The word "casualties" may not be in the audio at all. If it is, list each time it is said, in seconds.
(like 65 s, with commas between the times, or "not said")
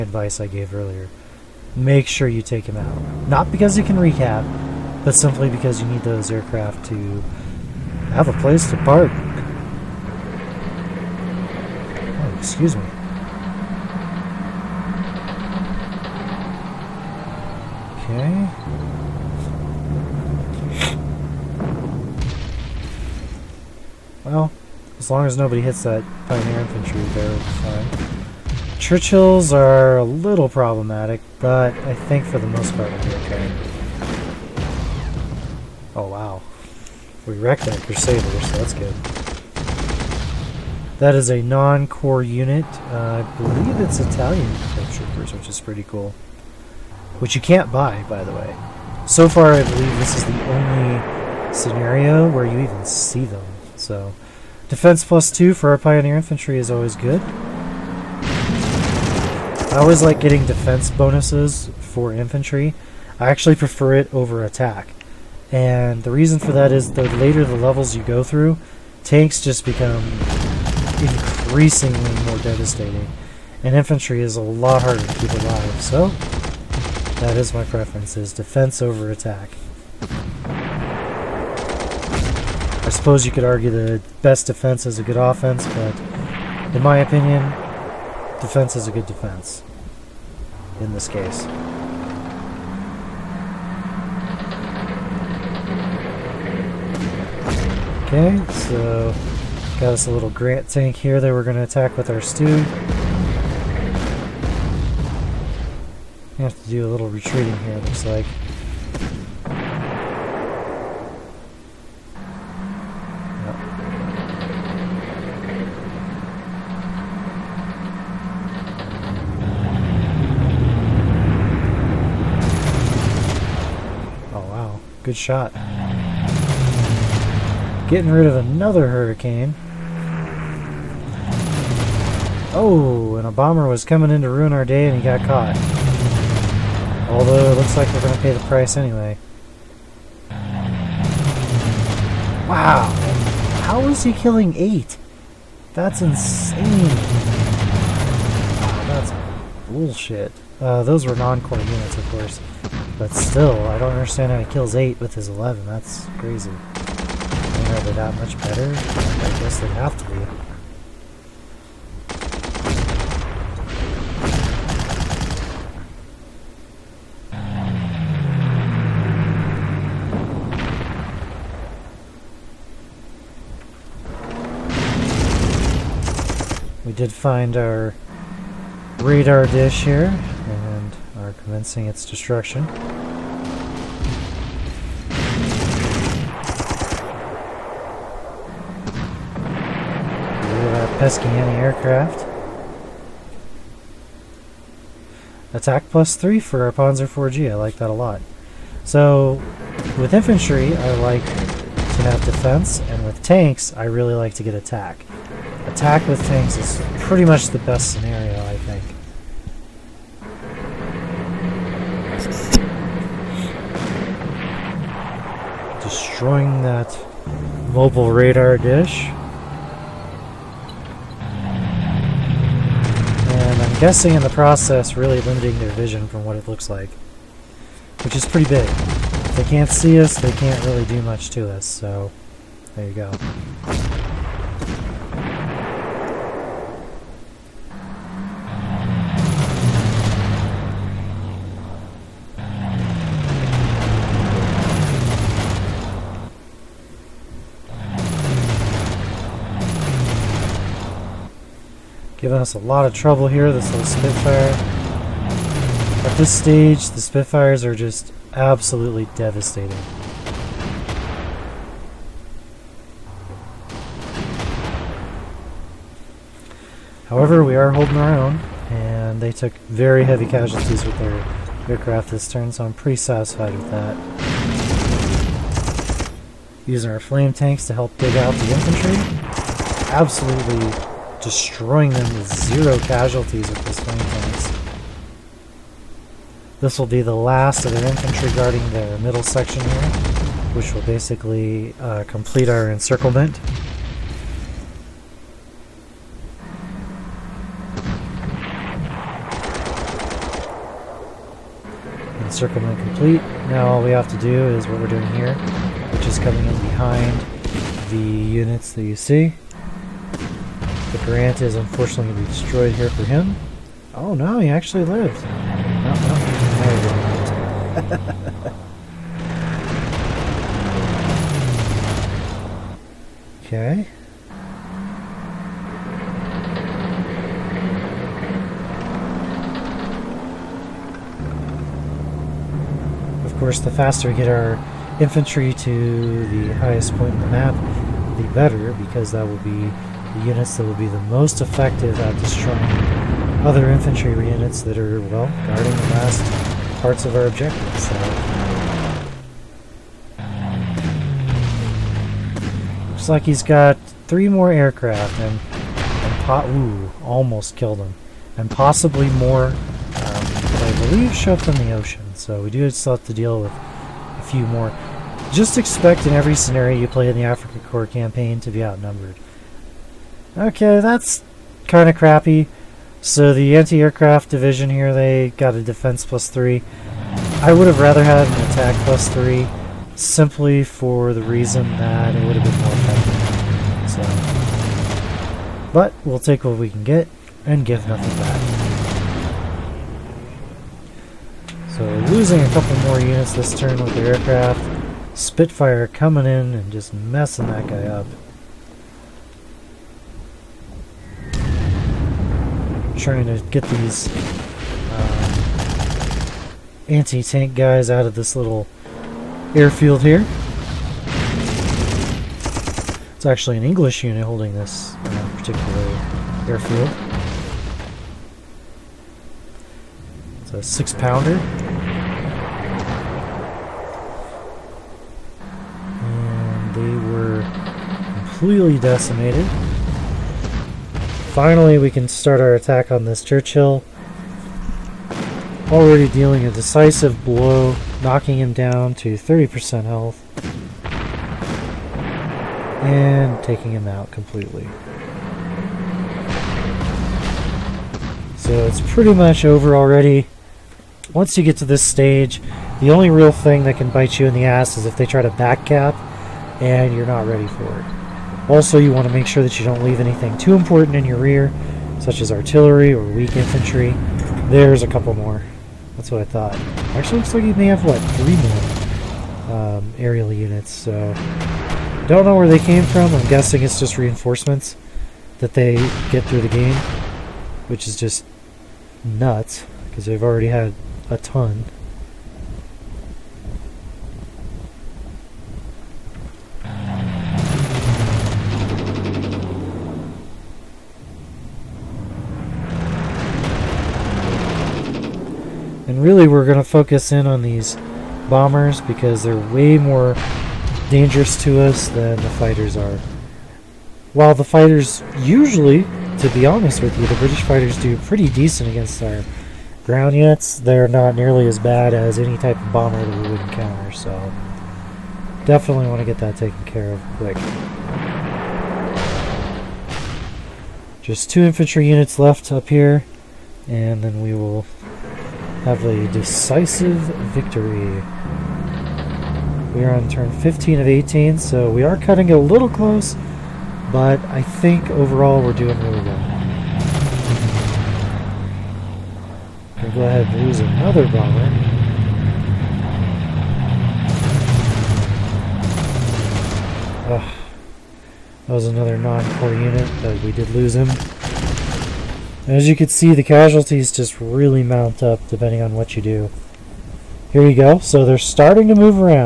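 270 s, 282 s, 553 s.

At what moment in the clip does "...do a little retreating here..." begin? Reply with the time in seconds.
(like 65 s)
106 s.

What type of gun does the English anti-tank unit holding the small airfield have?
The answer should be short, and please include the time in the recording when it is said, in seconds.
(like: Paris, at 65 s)
Six pounder, at 420 s.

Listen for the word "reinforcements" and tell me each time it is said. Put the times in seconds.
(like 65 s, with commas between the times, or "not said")
473 s.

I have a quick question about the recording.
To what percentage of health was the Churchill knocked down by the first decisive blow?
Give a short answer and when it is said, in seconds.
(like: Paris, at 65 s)
30%, at 439 s.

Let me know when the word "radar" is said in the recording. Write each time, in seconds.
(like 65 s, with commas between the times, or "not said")
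179 s, 218 s.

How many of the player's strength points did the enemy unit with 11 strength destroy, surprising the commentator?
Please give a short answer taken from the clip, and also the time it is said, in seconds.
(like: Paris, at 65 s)
8, at 144 s.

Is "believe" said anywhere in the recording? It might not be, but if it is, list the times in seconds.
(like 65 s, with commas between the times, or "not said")
43 s, 49 s, 360 s.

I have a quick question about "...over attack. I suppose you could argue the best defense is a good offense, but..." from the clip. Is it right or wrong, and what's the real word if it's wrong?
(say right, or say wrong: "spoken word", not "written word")
right.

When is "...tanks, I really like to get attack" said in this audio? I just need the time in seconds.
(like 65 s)
203 s.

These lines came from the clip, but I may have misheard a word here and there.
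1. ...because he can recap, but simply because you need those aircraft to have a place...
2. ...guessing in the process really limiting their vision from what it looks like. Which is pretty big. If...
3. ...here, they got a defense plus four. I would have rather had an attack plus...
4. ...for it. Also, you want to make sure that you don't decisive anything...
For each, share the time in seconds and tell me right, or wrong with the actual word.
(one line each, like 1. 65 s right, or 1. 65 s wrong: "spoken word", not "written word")
1. 3 s right
2. 223 s right
3. 374 s wrong: "three", not "four"
4. 457 s wrong: "leave", not "decisive".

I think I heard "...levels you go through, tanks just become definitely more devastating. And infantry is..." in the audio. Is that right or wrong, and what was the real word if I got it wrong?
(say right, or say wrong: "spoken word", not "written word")
wrong: "increasingly", not "definitely".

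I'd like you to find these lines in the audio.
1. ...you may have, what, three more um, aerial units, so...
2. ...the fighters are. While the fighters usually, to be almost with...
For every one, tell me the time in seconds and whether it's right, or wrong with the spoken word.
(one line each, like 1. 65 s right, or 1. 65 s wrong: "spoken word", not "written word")
1. 467 s right
2. 502 s wrong: "honest", not "almost".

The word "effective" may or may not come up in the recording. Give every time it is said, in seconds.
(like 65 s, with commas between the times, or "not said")
341 s, 384 s.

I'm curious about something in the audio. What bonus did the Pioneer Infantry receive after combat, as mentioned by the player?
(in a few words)
Defense plus 2.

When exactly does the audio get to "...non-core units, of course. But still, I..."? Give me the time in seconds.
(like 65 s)
151 s.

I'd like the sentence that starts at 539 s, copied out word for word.
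We'll go ahead and lose another bomber.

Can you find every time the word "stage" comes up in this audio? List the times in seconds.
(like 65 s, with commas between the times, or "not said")
256 s, 451 s.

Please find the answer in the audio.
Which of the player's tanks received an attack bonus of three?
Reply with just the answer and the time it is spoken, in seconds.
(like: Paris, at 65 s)
Panzer 4G, at 196 s.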